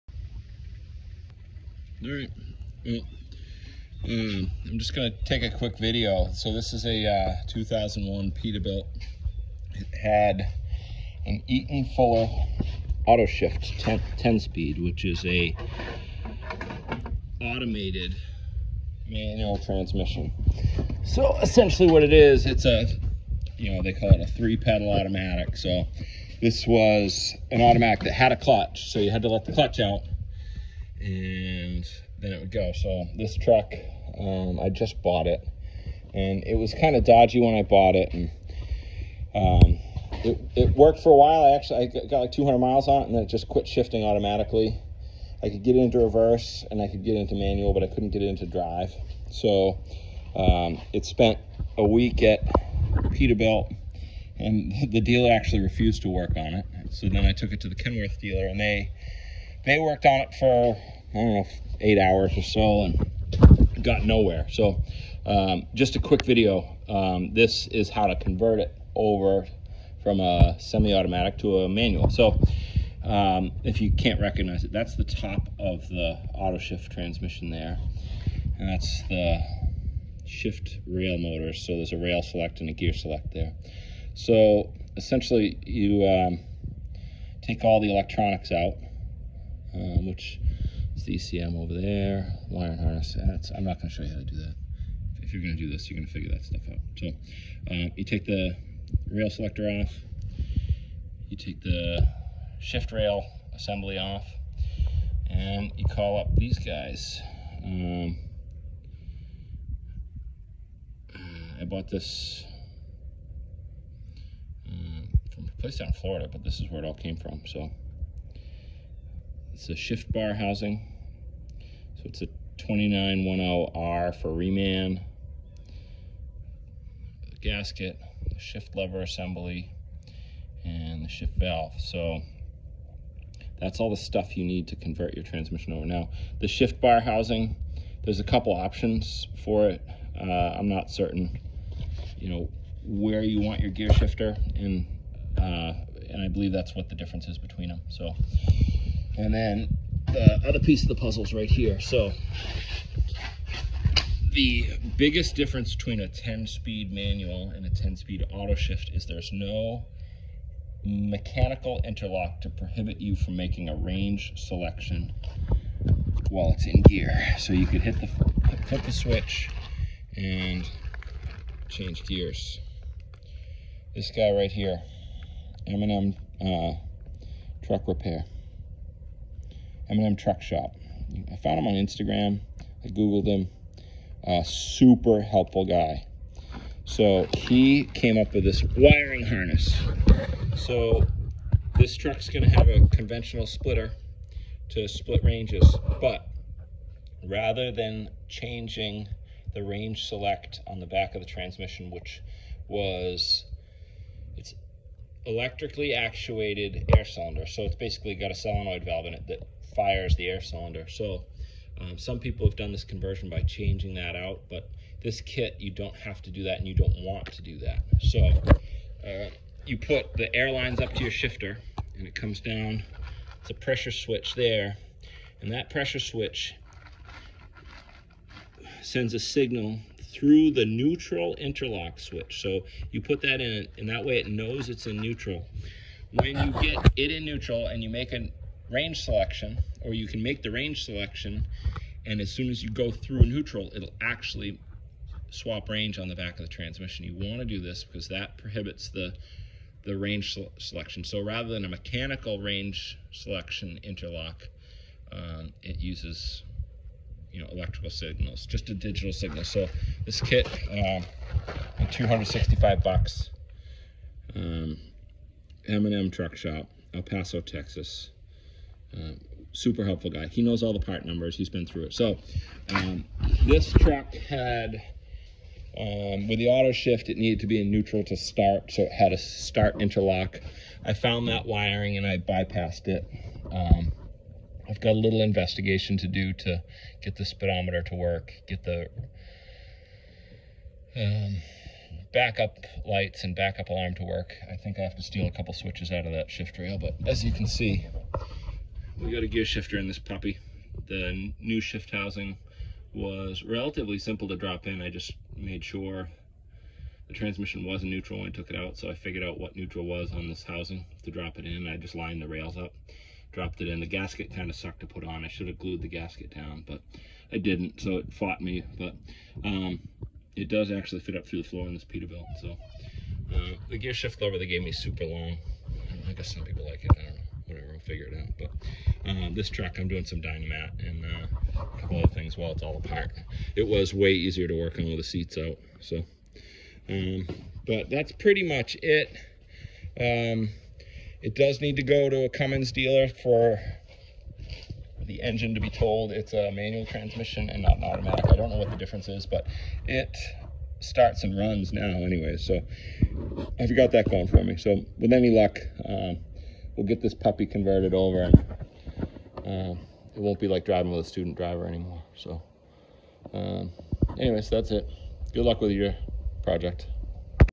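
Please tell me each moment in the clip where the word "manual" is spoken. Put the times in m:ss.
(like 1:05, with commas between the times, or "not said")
0:19, 0:47, 1:11, 2:36, 5:46.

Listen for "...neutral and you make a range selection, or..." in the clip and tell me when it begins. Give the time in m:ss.
3:57.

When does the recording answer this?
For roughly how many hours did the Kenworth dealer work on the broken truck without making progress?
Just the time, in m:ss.
1:01.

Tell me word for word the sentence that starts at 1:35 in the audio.
If you're going to do this, you're going to figure that stuff out.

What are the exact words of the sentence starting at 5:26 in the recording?
I, guess some people like it.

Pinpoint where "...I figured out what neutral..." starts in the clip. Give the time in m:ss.
5:08.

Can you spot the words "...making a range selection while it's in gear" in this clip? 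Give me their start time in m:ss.
2:43.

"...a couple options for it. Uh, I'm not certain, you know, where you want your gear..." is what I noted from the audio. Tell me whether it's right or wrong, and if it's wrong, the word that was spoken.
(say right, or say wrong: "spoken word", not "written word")
right.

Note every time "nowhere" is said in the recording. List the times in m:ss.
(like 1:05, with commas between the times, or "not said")
1:04.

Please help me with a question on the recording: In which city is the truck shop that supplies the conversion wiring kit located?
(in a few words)
El Paso, Texas.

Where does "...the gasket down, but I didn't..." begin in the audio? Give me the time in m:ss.
5:15.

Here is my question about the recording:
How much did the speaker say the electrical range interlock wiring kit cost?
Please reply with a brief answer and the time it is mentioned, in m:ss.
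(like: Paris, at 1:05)
$265, at 4:21.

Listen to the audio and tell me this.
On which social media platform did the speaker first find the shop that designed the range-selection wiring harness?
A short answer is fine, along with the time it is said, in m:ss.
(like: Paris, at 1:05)
Instagram, at 3:01.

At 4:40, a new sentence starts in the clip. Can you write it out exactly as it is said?
I found that wiring and I bypassed it.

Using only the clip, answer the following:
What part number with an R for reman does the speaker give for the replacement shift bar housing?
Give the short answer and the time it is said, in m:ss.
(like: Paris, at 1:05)
2910R, at 2:02.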